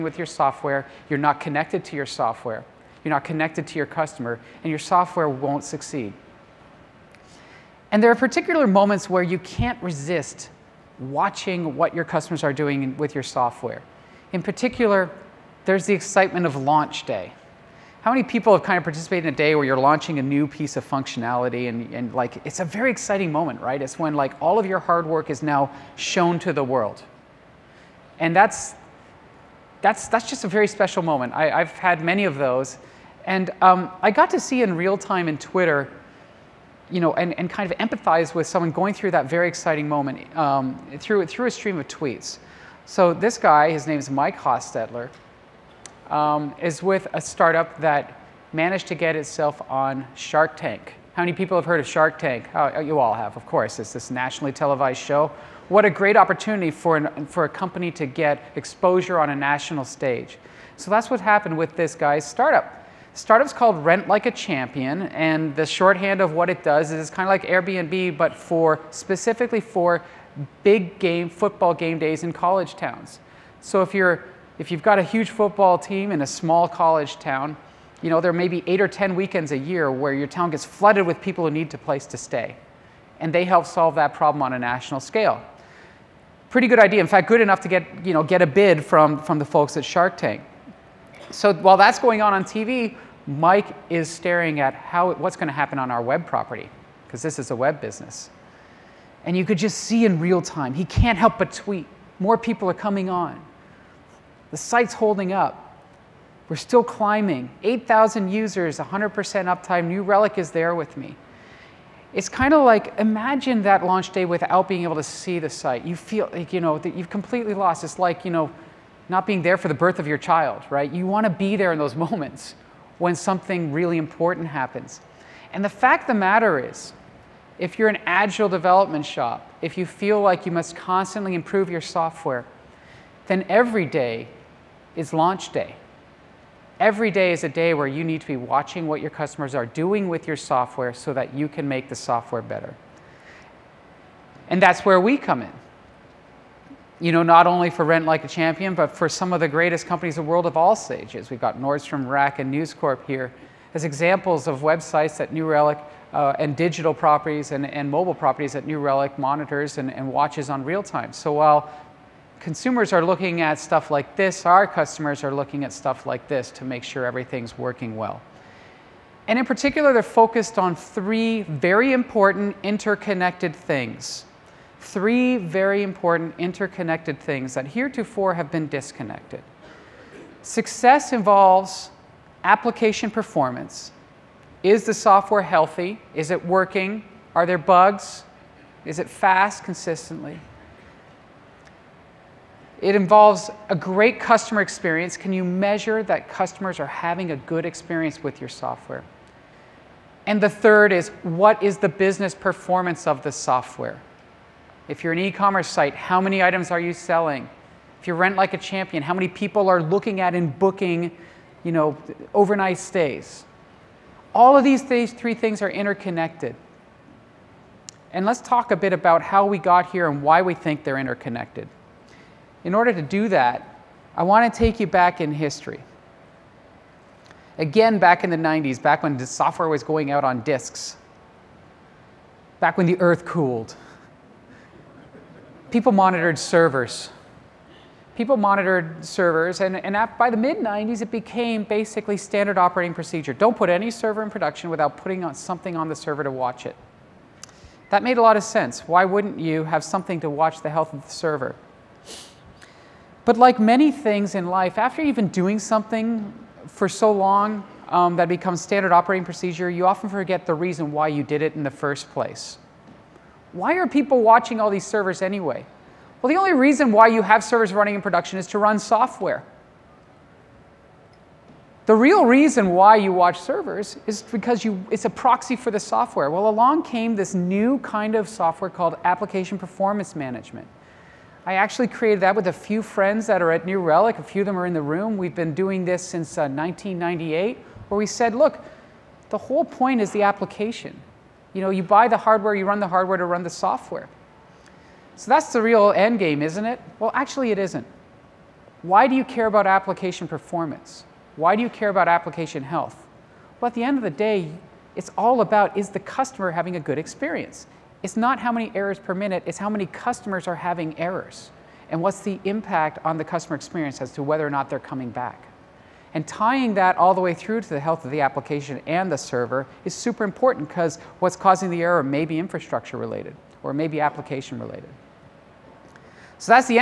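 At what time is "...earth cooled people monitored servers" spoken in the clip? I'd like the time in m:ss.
3:53.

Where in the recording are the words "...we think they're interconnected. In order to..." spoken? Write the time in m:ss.
3:40.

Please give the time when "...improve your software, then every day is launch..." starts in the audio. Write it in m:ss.
2:11.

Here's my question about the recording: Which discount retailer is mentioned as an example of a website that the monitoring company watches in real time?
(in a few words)
Nordstrom Rack.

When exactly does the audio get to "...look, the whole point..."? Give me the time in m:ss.
4:48.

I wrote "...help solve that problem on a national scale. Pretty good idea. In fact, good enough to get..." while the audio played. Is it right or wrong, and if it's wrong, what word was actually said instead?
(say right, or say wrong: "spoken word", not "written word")
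right.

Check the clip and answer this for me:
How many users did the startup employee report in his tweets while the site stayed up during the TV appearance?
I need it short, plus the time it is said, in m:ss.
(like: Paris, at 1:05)
8,000, at 1:47.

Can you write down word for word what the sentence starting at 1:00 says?
So that's what happened with this guy's startup.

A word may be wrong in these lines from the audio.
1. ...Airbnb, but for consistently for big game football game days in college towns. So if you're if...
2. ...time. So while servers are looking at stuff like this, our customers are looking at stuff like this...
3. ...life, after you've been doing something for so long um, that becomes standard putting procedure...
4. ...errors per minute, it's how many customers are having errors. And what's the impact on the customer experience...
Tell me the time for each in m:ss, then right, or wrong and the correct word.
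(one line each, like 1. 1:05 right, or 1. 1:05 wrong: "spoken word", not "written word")
1. 1:07 wrong: "specifically", not "consistently"
2. 2:40 wrong: "consumers", not "servers"
3. 4:14 wrong: "operating", not "putting"
4. 5:08 right.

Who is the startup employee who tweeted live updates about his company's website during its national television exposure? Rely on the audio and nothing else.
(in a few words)
Mike Hostetler.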